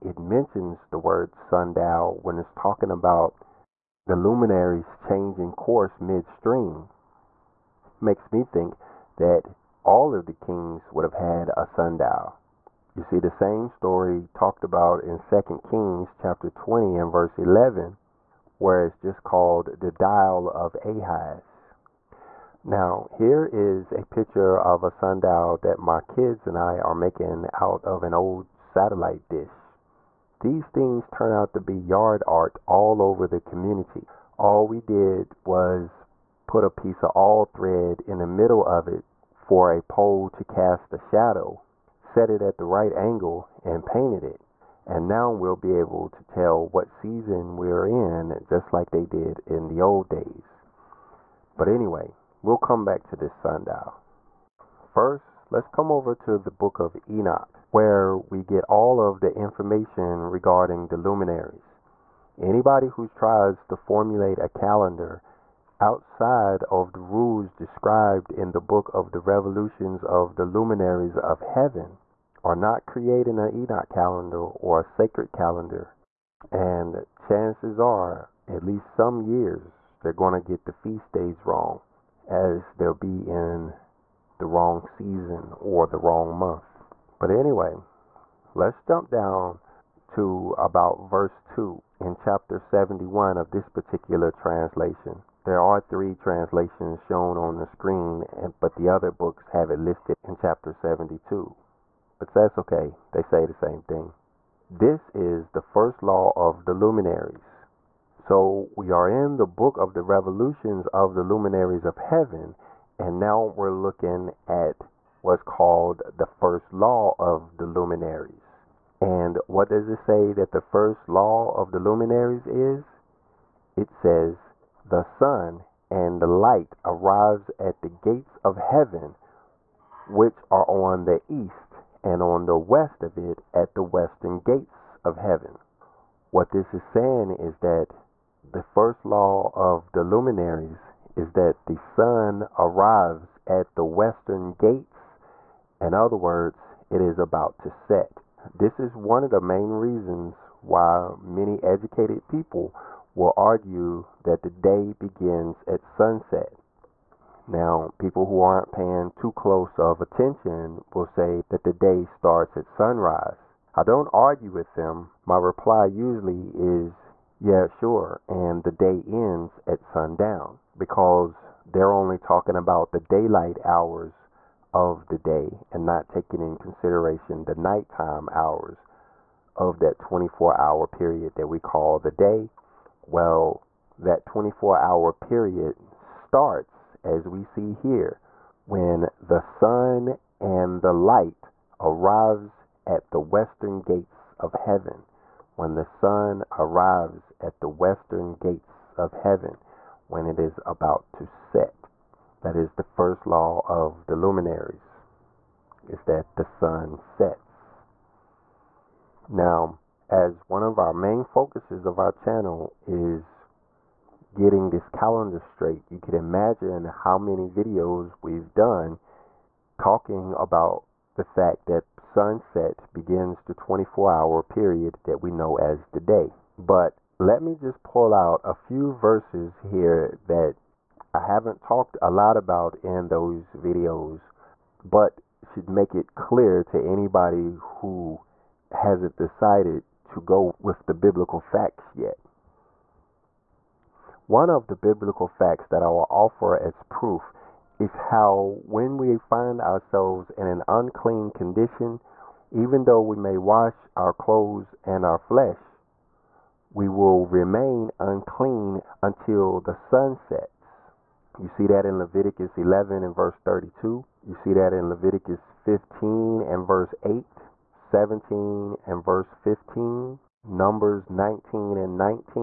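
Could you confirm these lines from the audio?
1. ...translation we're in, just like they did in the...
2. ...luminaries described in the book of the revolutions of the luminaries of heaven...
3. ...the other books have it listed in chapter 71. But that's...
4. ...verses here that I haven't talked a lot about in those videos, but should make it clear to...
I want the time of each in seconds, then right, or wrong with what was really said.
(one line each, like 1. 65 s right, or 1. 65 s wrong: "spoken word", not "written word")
1. 46 s wrong: "season", not "translation"
2. 67 s wrong: "rules", not "luminaries"
3. 98 s wrong: "72", not "71"
4. 228 s right.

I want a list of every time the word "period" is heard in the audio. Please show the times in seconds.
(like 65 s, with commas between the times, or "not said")
180 s, 185 s, 224 s.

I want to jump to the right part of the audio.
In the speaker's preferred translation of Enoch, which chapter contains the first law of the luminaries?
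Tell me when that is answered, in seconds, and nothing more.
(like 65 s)
92 s.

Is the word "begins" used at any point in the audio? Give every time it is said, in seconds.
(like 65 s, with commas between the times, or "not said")
154 s, 222 s.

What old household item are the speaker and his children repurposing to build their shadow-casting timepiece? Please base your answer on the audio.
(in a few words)
satellite dish.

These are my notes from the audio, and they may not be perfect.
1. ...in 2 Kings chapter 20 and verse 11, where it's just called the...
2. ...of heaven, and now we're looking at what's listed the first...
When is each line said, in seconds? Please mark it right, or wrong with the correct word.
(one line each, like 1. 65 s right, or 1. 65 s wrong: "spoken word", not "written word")
1. 15 s right
2. 111 s wrong: "called", not "listed".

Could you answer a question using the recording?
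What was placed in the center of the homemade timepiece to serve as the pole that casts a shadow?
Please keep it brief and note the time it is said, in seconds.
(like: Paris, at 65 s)
all thread, at 37 s.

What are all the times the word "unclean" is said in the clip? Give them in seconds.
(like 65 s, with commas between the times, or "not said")
250 s, 257 s.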